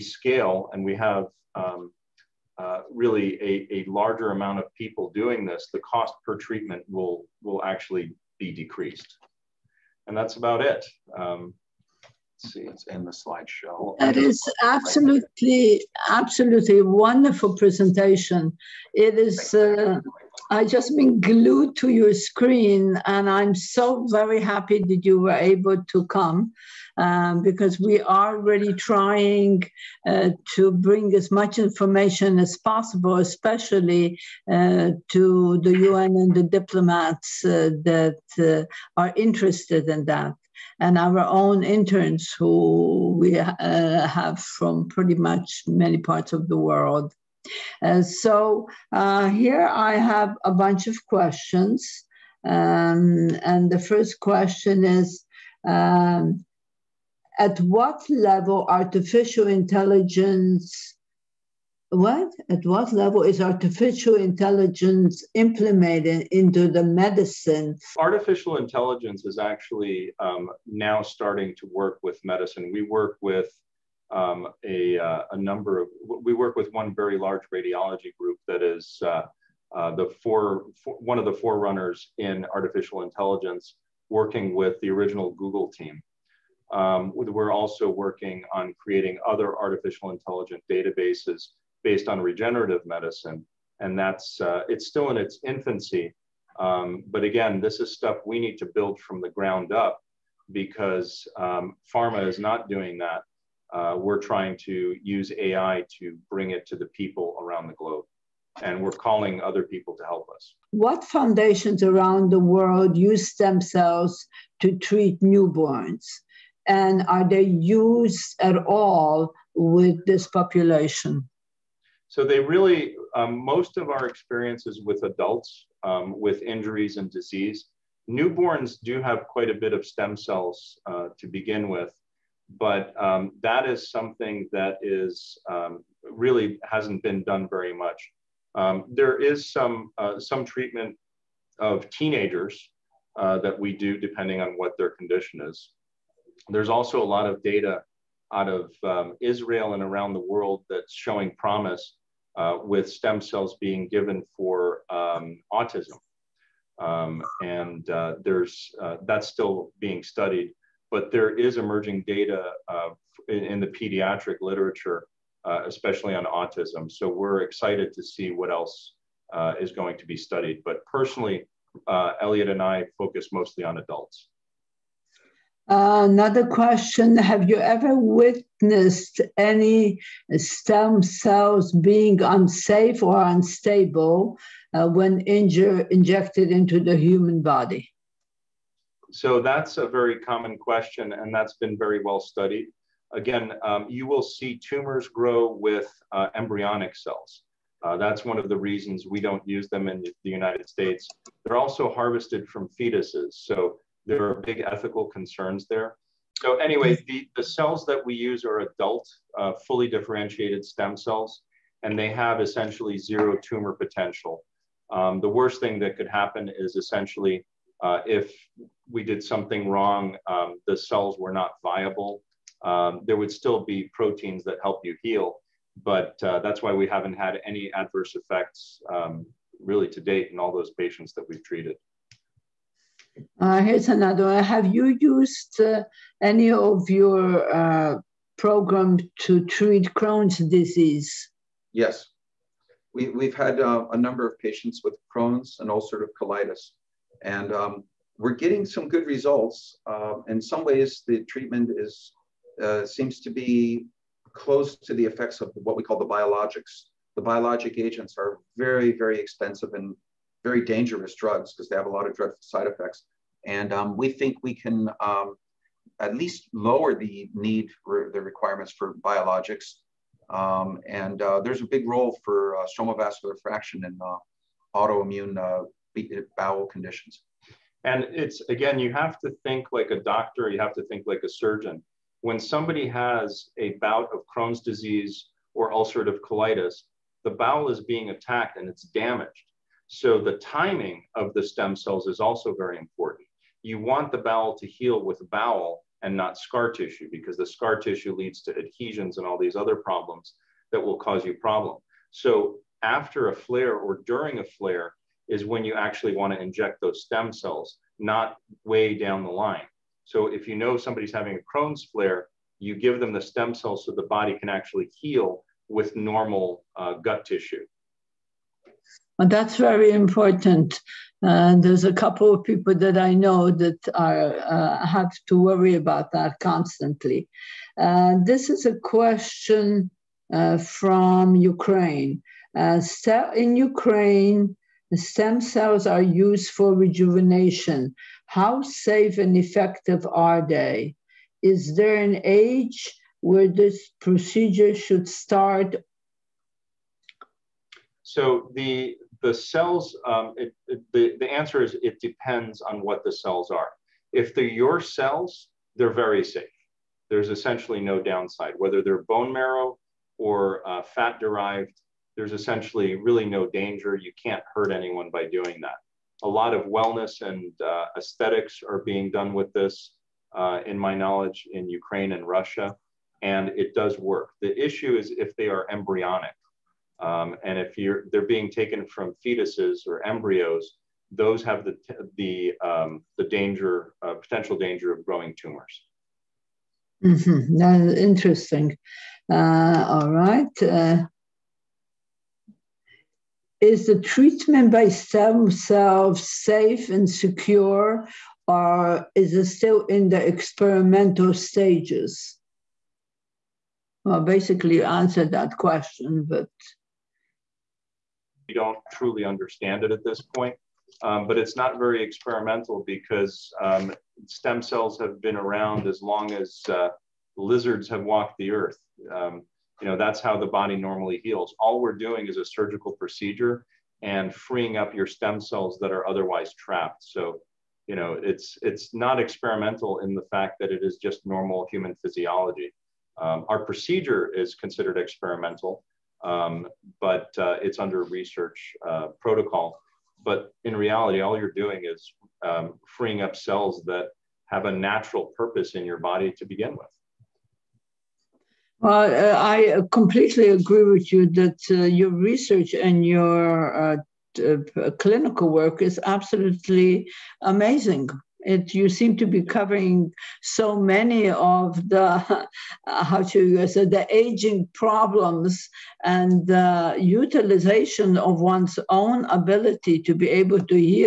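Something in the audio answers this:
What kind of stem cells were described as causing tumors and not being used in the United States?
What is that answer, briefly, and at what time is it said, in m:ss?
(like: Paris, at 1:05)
Embryonic cells, at 3:16.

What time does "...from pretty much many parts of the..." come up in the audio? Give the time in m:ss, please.
0:44.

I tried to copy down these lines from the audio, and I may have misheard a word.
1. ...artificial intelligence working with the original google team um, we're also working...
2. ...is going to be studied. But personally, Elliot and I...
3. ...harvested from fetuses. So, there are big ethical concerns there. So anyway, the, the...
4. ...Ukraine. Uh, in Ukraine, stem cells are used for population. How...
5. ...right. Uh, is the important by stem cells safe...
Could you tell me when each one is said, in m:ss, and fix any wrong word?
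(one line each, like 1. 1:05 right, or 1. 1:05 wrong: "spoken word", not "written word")
1. 1:22 right
2. 2:49 right
3. 3:21 right
4. 5:31 wrong: "rejuvenation", not "population"
5. 6:30 wrong: "treatment", not "important".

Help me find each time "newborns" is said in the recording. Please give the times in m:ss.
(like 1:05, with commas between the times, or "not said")
1:55, 2:08.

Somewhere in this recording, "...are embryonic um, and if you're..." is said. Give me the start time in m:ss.
6:15.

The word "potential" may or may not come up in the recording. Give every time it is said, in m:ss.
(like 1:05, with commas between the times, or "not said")
3:33, 6:24.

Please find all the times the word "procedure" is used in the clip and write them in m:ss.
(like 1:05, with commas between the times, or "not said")
5:44, 7:02, 7:13.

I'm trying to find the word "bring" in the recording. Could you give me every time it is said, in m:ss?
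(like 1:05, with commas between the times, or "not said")
0:30, 1:46.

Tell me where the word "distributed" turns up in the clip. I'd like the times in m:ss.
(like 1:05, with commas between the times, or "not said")
not said.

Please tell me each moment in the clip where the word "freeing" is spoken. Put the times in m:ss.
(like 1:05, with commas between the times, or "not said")
7:04, 7:22.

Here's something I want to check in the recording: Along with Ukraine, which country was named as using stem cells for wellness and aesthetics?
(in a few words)
Russia.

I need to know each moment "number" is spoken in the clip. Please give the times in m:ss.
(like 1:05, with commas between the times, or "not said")
1:15, 4:03.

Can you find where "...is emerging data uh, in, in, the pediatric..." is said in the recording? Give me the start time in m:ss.
2:41.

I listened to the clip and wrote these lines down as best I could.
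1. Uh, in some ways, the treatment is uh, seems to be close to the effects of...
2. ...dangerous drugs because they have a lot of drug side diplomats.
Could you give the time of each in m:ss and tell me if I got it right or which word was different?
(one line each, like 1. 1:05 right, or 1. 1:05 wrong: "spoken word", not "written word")
1. 4:09 right
2. 4:20 wrong: "effects", not "diplomats".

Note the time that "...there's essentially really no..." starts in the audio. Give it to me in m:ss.
6:02.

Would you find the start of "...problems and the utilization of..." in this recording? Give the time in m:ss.
7:44.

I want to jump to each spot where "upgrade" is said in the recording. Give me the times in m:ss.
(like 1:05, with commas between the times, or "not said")
not said.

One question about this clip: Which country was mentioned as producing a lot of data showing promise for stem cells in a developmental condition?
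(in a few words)
Israel.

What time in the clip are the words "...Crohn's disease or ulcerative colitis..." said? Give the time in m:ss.
4:44.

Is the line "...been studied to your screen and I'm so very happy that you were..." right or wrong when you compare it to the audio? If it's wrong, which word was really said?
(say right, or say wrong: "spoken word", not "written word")
wrong: "glued", not "studied".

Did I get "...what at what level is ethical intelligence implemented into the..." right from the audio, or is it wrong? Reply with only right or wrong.
wrong.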